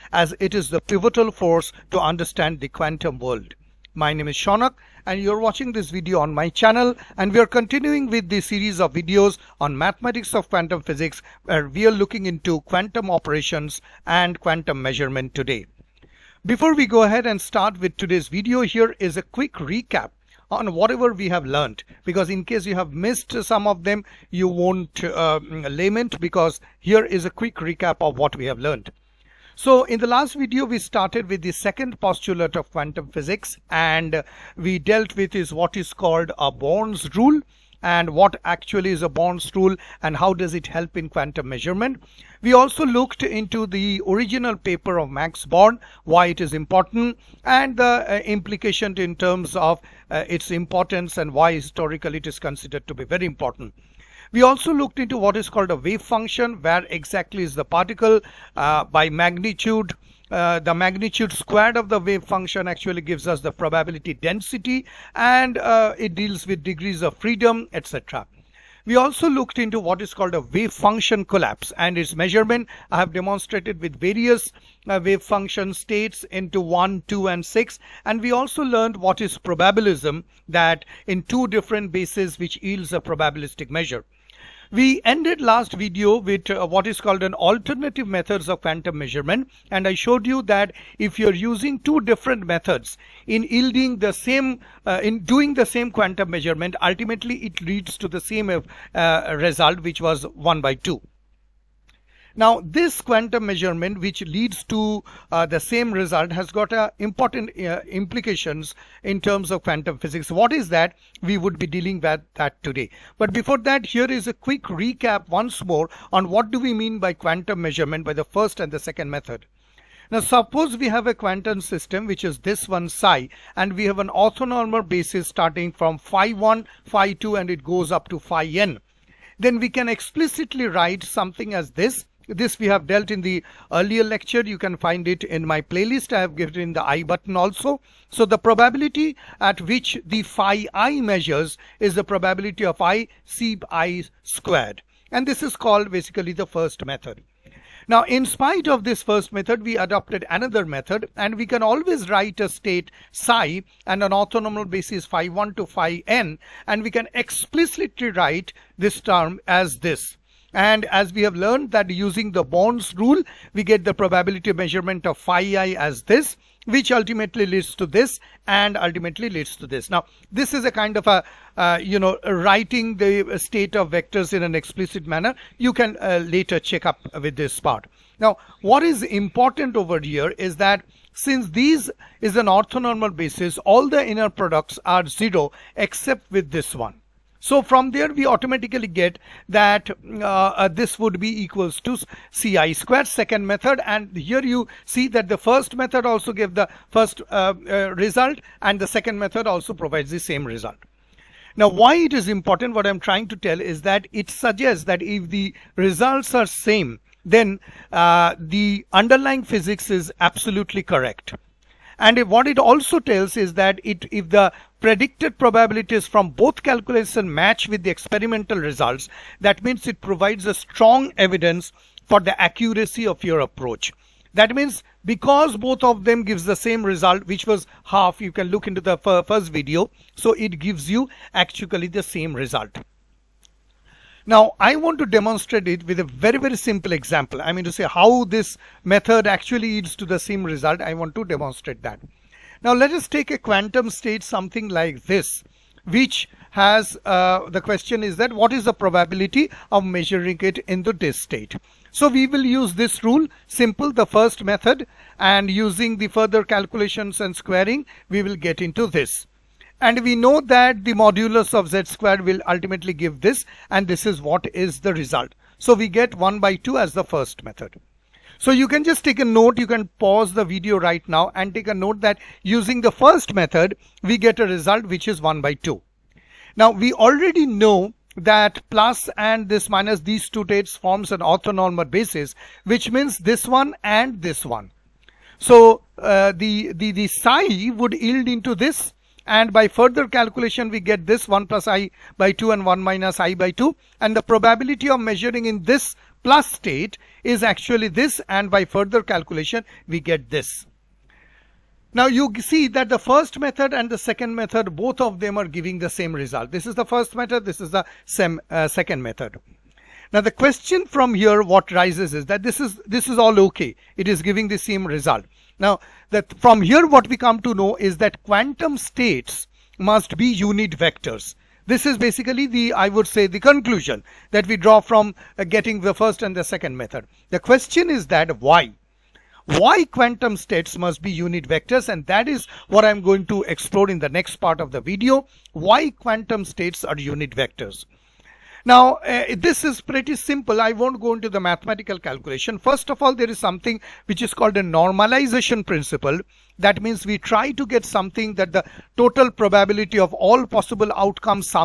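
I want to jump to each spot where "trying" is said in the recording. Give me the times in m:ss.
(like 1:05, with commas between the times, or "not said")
3:22.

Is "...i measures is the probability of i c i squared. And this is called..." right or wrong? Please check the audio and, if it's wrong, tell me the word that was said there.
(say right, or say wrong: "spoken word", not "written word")
right.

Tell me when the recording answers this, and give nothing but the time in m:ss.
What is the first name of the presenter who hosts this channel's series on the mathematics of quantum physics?
0:04.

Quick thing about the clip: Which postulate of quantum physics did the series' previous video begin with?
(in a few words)
Second postulate.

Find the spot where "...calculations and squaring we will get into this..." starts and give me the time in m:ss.
4:16.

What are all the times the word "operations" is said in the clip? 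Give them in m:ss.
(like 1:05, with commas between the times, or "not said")
0:13.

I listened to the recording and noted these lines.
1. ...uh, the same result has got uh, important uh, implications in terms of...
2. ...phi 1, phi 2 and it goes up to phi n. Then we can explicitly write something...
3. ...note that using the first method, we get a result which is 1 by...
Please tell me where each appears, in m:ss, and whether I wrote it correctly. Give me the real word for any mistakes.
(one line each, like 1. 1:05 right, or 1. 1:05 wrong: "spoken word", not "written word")
1. 1:45 right
2. 2:05 right
3. 4:31 right.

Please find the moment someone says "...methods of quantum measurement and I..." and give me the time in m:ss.
1:28.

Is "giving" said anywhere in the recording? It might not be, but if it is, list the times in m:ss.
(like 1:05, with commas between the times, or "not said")
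5:05, 5:14.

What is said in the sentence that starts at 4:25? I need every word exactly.
So we get 1 by 2 as the first method.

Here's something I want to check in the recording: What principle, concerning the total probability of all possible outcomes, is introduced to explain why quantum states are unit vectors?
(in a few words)
Normalization principle.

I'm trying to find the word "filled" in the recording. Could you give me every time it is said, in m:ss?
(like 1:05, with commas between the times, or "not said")
not said.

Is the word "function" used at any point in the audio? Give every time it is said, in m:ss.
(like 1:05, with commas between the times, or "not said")
0:56, 1:02, 1:10, 1:15.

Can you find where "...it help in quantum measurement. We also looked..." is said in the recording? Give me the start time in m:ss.
0:40.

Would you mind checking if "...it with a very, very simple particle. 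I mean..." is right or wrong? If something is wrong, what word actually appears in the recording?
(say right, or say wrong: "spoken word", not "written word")
wrong: "example", not "particle".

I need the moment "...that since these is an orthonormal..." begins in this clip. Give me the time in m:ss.
3:00.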